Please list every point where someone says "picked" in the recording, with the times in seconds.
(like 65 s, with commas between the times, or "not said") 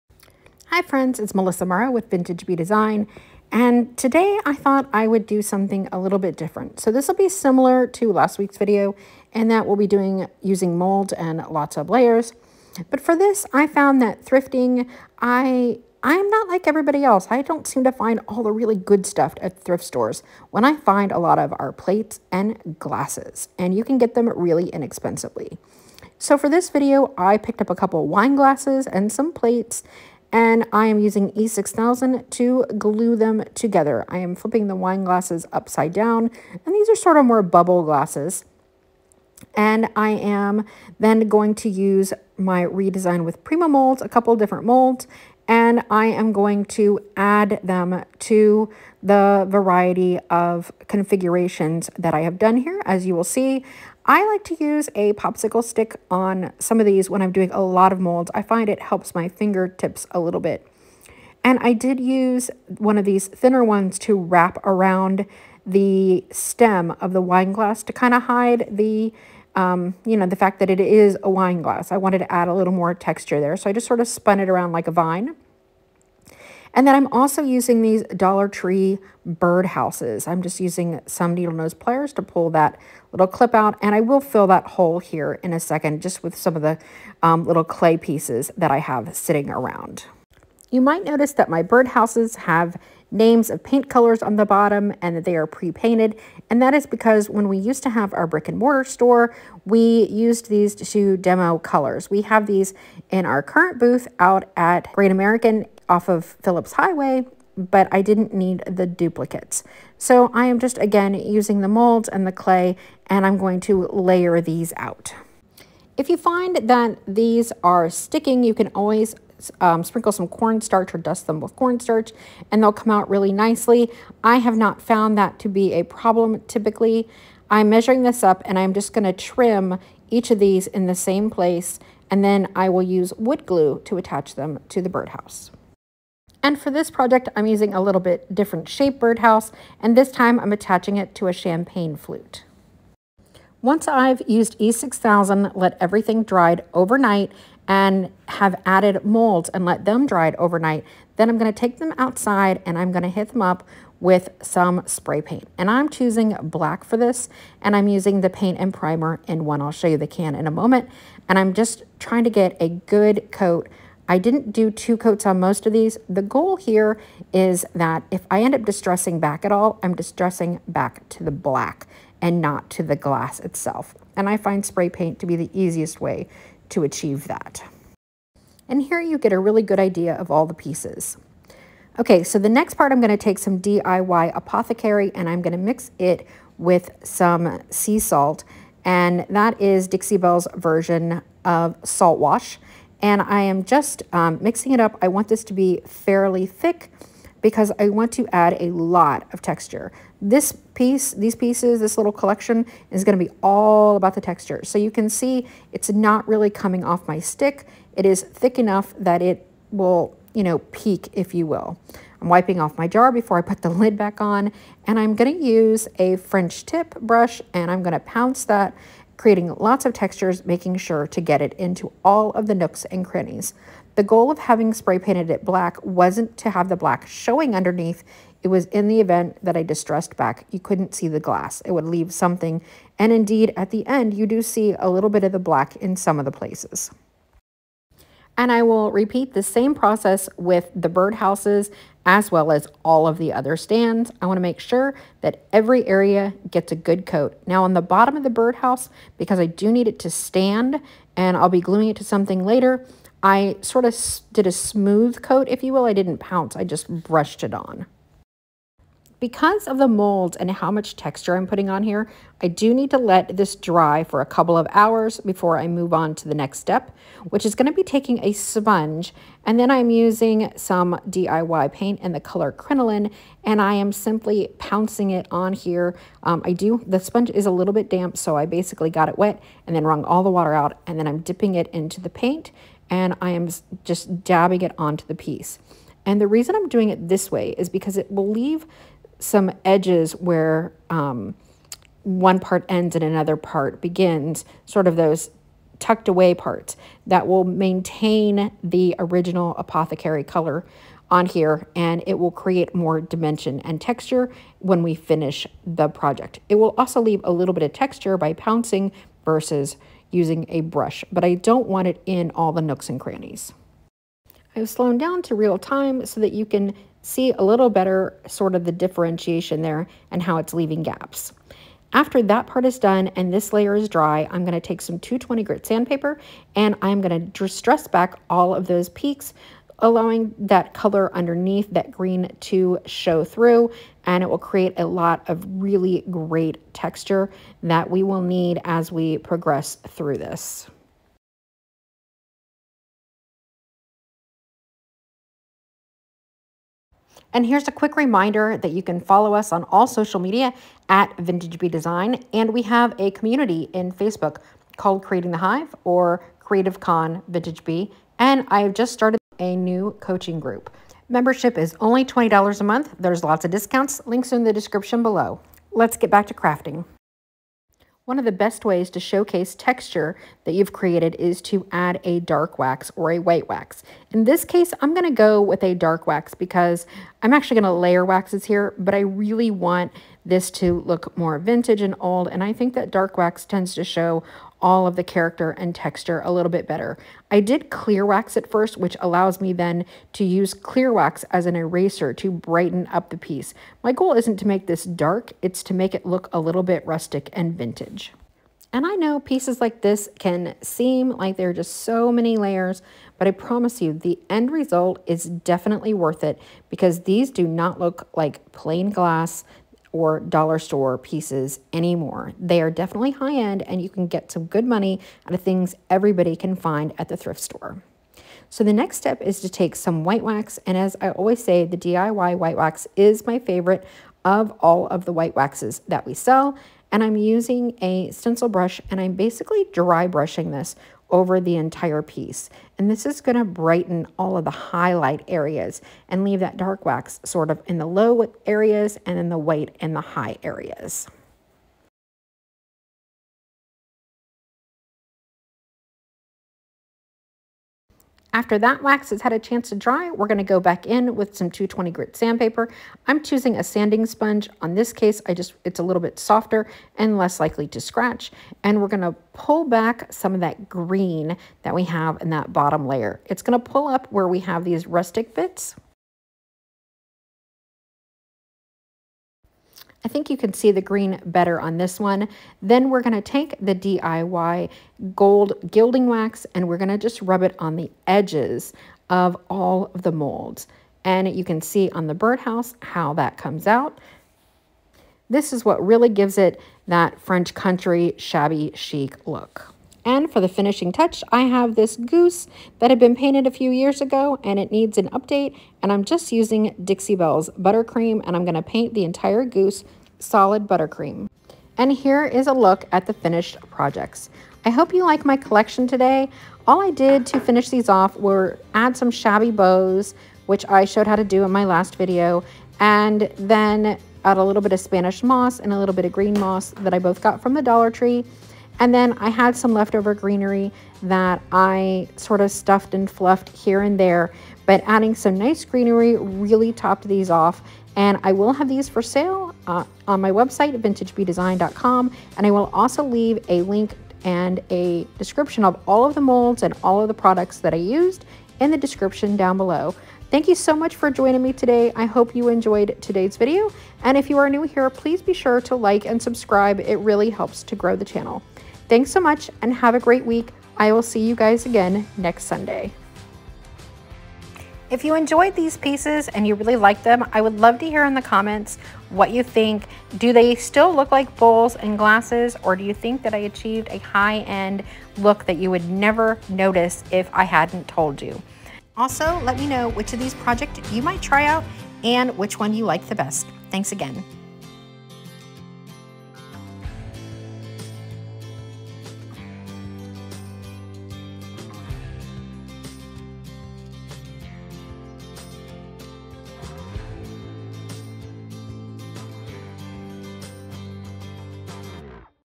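27 s.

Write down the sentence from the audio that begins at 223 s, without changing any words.
The goal of having spray painted it black wasn't to have the black showing underneath.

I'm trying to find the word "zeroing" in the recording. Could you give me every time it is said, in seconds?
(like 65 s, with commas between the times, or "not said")
not said.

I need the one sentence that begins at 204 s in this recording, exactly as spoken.
So you can see it's not really coming off my stick.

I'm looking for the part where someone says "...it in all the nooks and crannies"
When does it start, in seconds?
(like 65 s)
311 s.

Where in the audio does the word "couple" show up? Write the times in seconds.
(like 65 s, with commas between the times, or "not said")
27 s, 44 s, 264 s.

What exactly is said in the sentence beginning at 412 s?
They are definitely high end and you can get some good money out of things everybody can find at the thrift store.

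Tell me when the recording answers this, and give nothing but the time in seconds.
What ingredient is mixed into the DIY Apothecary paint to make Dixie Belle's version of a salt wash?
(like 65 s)
187 s.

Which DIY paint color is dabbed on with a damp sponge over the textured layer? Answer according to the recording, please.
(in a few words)
Crinoline.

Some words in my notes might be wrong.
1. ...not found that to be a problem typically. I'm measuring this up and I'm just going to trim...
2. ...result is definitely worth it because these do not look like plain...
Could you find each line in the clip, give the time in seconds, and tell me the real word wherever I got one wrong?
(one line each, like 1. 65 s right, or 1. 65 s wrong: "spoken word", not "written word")
1. 124 s right
2. 404 s right.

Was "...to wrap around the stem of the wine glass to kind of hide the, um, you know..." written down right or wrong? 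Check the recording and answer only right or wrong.
right.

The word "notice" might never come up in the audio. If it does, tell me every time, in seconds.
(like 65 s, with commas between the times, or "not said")
91 s, 566 s.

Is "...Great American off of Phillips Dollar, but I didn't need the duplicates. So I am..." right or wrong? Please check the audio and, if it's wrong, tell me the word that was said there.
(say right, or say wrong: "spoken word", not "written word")
wrong: "Highway", not "Dollar".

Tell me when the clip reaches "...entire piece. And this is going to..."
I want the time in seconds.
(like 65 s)
431 s.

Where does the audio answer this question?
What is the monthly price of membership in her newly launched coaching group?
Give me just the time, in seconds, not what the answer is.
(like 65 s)
362 s.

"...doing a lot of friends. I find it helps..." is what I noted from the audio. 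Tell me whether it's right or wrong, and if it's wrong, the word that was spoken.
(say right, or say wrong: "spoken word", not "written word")
wrong: "molds", not "friends".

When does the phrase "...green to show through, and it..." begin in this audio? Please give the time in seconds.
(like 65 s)
331 s.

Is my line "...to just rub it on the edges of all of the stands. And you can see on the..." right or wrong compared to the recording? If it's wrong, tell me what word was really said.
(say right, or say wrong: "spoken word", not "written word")
wrong: "molds", not "stands".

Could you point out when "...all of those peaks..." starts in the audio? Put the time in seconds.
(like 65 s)
328 s.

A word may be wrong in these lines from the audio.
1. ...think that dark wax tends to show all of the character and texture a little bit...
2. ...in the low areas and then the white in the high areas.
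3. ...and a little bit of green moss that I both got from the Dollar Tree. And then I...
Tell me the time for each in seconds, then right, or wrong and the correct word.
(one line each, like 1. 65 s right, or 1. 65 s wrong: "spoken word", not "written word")
1. 382 s right
2. 437 s right
3. 515 s right.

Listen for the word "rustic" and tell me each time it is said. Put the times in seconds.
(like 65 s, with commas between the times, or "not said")
396 s, 464 s.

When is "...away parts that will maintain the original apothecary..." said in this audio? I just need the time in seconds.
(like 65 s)
296 s.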